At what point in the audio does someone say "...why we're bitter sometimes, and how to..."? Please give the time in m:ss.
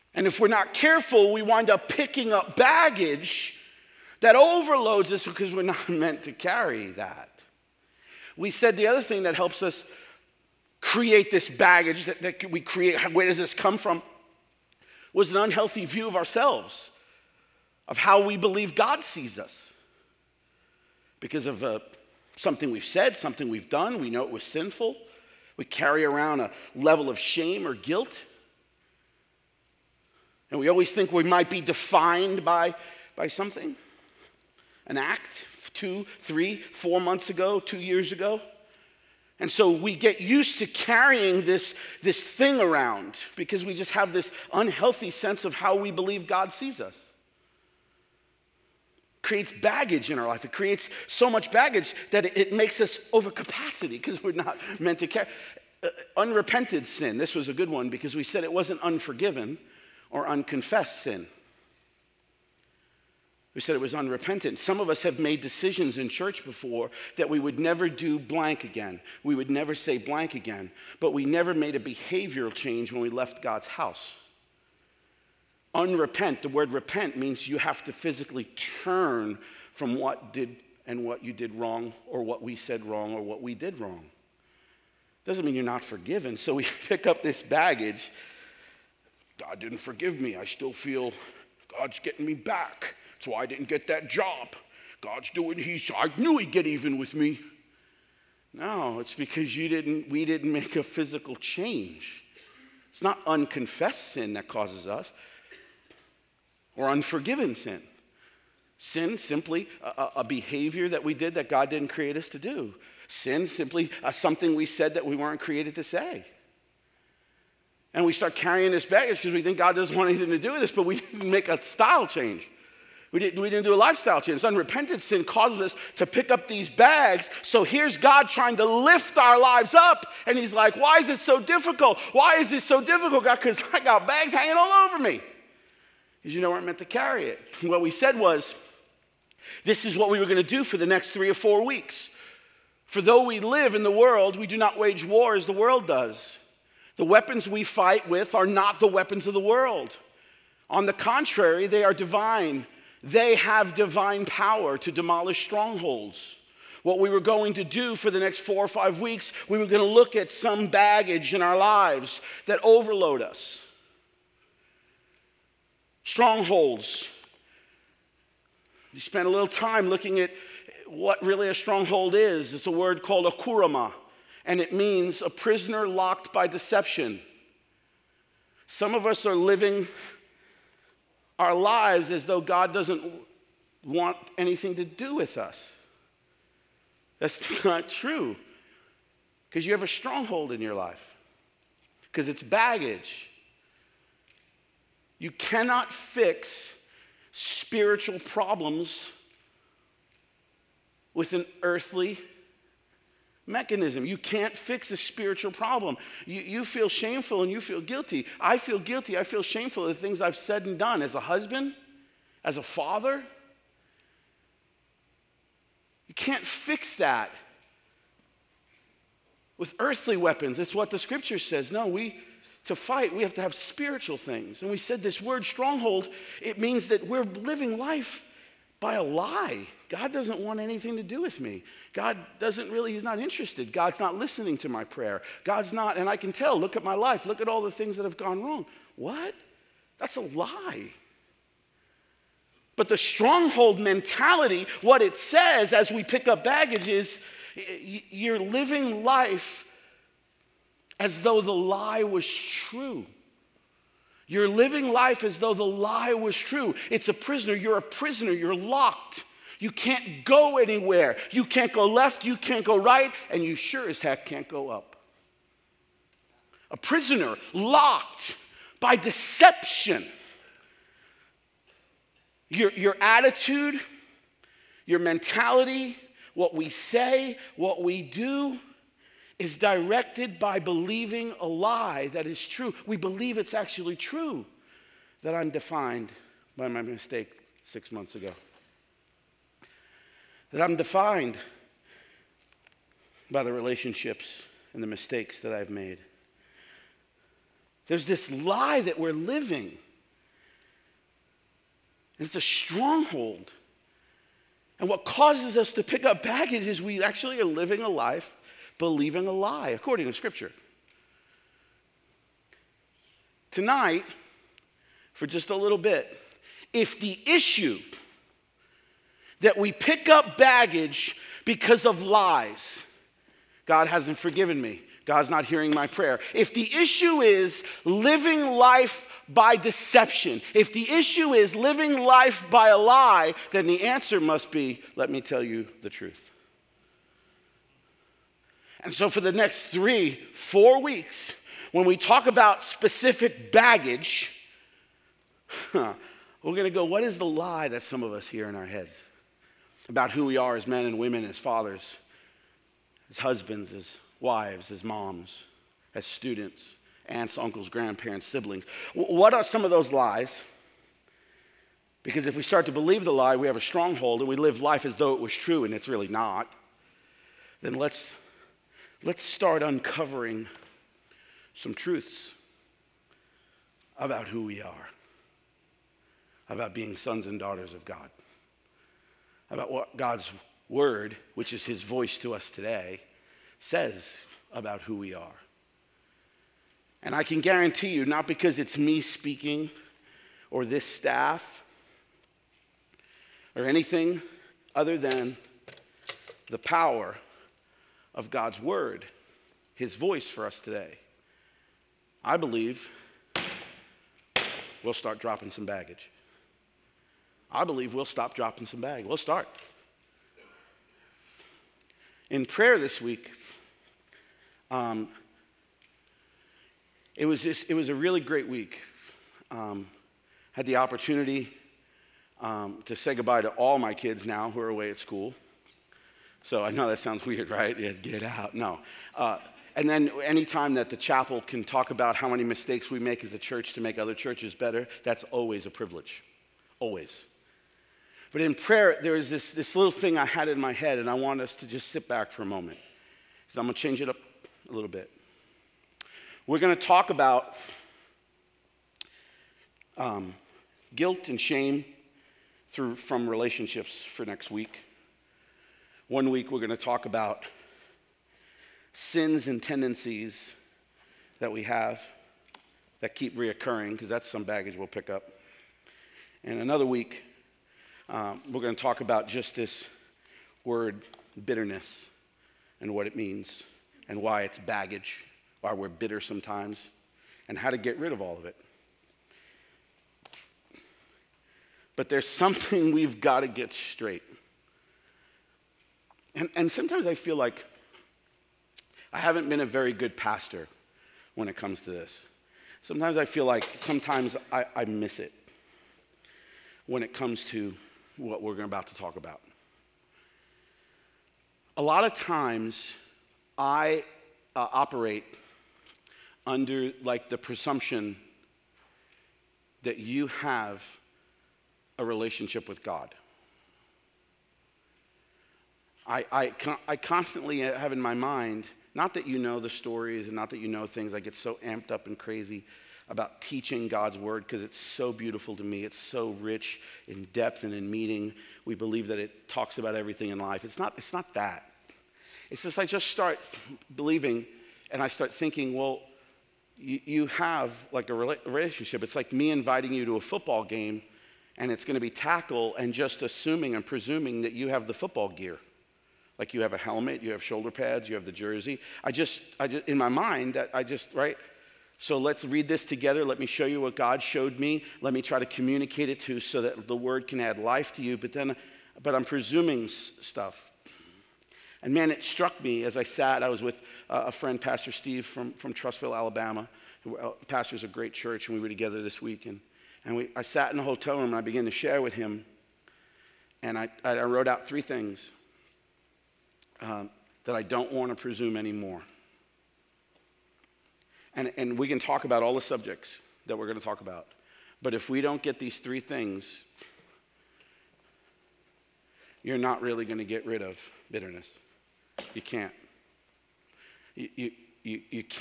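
7:55.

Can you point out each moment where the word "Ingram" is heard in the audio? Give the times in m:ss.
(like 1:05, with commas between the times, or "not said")
not said.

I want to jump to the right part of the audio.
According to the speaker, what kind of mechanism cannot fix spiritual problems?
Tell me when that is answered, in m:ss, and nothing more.
3:21.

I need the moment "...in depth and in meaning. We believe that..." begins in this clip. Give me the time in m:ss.
8:47.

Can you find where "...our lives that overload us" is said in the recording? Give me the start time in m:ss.
2:41.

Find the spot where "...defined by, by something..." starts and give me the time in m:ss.
0:31.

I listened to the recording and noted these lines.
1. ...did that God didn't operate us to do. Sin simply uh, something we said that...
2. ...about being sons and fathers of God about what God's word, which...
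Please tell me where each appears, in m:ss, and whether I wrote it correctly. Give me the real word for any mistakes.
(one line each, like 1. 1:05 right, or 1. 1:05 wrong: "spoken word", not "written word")
1. 1:51 wrong: "create", not "operate"
2. 6:16 wrong: "daughters", not "fathers".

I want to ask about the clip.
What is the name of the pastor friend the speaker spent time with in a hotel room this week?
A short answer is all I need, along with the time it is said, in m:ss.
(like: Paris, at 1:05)
Steve, at 9:24.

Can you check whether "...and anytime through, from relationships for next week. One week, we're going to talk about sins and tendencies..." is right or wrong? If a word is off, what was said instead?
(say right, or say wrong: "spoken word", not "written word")
wrong: "shame", not "anytime".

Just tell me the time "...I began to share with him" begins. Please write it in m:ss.
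9:31.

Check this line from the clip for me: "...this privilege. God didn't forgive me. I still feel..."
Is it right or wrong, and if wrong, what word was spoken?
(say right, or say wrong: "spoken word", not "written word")
wrong: "baggage", not "privilege".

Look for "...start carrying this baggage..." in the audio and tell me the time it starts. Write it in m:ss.
1:58.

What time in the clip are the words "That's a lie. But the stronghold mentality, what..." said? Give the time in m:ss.
3:59.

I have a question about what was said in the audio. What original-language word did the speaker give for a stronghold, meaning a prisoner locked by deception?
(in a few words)
Kurama.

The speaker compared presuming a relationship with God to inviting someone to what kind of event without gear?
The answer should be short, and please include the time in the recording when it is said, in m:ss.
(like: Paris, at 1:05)
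A football game, at 9:00.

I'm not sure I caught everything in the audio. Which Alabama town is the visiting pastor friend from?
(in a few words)
Trussville.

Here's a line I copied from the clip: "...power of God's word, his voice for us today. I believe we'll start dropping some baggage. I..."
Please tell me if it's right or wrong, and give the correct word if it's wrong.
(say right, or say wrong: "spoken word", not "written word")
right.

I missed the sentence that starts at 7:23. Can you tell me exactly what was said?
So I'm going to change it up a little bit.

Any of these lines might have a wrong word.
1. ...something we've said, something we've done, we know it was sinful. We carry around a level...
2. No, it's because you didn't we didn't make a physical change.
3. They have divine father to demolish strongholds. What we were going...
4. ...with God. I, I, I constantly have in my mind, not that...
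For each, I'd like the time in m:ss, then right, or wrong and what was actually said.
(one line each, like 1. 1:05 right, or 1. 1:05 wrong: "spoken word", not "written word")
1. 0:22 right
2. 1:38 right
3. 2:33 wrong: "power", not "father"
4. 8:32 right.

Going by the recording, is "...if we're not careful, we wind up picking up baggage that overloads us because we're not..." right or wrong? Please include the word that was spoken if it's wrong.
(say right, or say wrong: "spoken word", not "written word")
right.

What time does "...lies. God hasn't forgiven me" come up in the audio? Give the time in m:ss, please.
5:22.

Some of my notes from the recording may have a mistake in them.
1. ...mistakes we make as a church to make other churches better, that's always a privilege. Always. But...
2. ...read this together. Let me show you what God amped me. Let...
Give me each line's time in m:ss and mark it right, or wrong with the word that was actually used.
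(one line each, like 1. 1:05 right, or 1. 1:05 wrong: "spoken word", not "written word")
1. 7:12 right
2. 9:12 wrong: "showed", not "amped".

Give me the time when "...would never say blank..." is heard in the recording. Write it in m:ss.
1:09.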